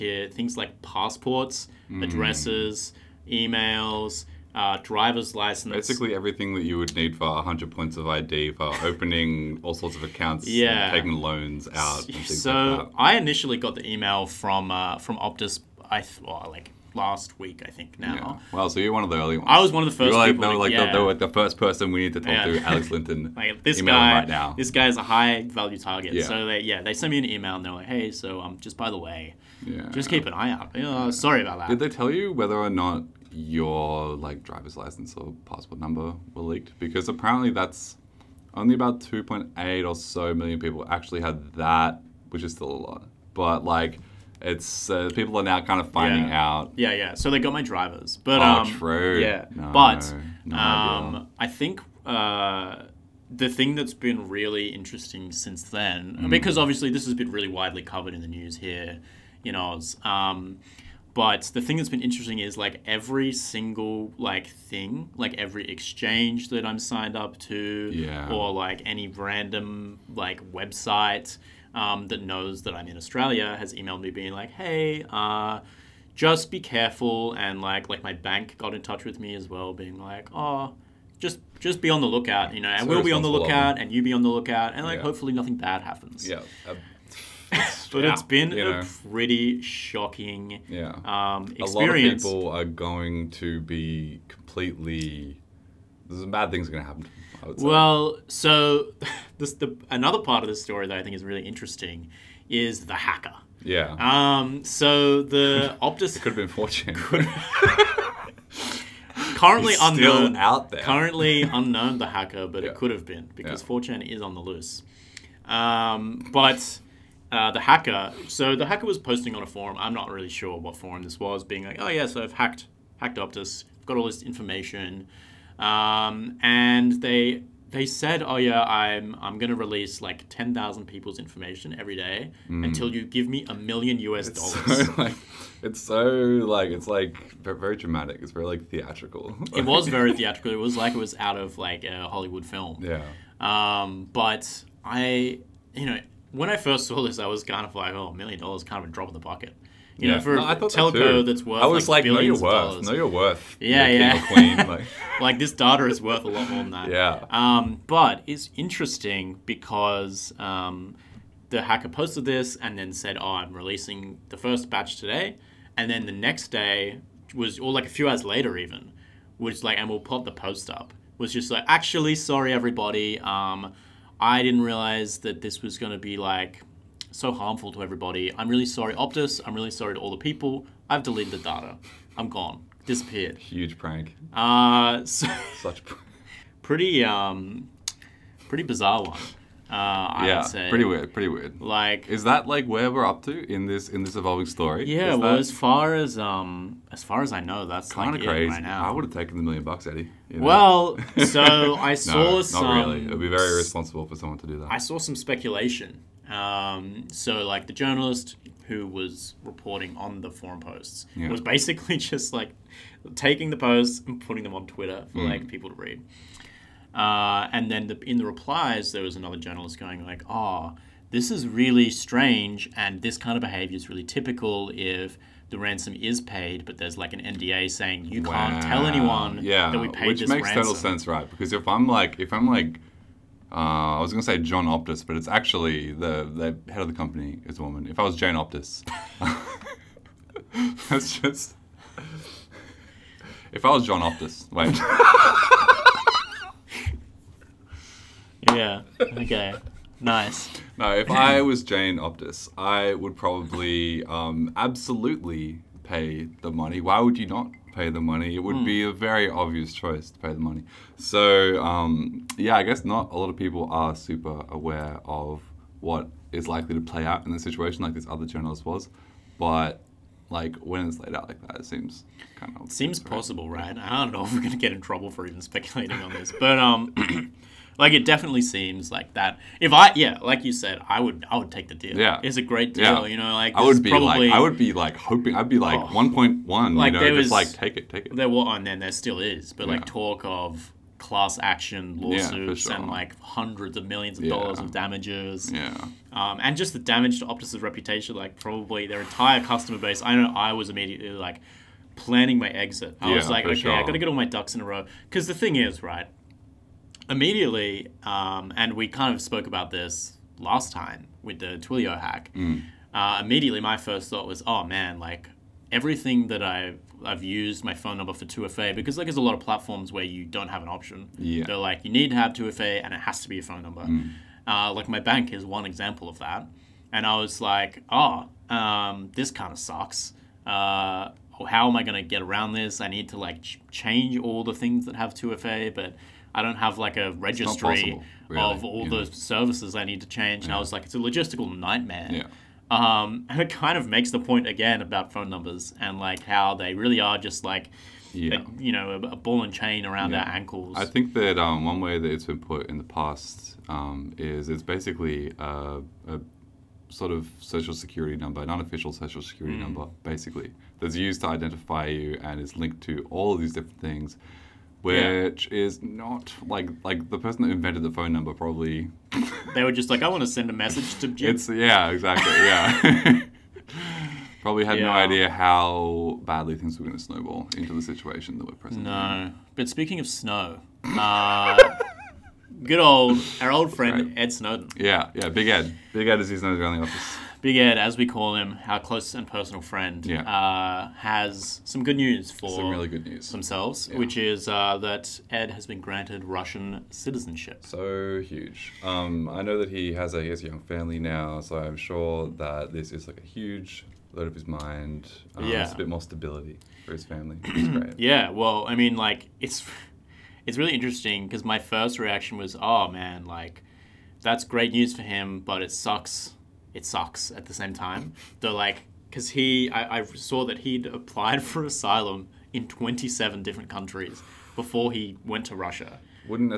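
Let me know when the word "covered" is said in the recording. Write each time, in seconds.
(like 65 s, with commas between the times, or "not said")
57 s.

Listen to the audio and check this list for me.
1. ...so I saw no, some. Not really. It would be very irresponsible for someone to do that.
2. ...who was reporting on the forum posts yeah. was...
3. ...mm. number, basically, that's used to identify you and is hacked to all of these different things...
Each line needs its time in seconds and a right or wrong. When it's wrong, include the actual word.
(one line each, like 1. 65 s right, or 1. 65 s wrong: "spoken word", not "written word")
1. 201 s right
2. 208 s right
3. 359 s wrong: "linked", not "hacked".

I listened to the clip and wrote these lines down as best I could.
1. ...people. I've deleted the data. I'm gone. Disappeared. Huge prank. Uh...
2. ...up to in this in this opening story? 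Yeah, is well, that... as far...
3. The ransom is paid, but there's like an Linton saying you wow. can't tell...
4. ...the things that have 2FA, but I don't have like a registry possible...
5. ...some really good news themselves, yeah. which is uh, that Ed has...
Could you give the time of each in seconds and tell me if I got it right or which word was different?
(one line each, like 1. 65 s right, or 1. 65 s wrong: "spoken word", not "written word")
1. 180 s right
2. 193 s wrong: "evolving", not "opening"
3. 225 s wrong: "NDA", not "Linton"
4. 334 s right
5. 392 s right.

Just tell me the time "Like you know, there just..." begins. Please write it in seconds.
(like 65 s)
286 s.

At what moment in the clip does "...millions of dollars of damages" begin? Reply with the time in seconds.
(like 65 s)
293 s.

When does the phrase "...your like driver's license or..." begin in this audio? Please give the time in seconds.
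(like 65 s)
33 s.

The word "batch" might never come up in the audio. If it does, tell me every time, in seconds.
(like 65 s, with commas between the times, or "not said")
164 s.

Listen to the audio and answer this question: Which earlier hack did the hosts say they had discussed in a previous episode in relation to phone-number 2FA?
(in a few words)
Twilio.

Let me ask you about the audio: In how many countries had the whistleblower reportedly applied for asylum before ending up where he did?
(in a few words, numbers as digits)
27.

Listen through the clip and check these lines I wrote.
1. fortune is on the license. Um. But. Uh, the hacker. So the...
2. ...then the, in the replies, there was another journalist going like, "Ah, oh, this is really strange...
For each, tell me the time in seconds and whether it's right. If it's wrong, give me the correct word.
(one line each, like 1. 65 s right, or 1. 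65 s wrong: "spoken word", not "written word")
1. 113 s wrong: "loose", not "license"
2. 217 s right.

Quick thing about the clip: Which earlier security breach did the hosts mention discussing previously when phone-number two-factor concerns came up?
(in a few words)
Twilio hack.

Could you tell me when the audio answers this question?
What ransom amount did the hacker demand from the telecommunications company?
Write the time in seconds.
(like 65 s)
133 s.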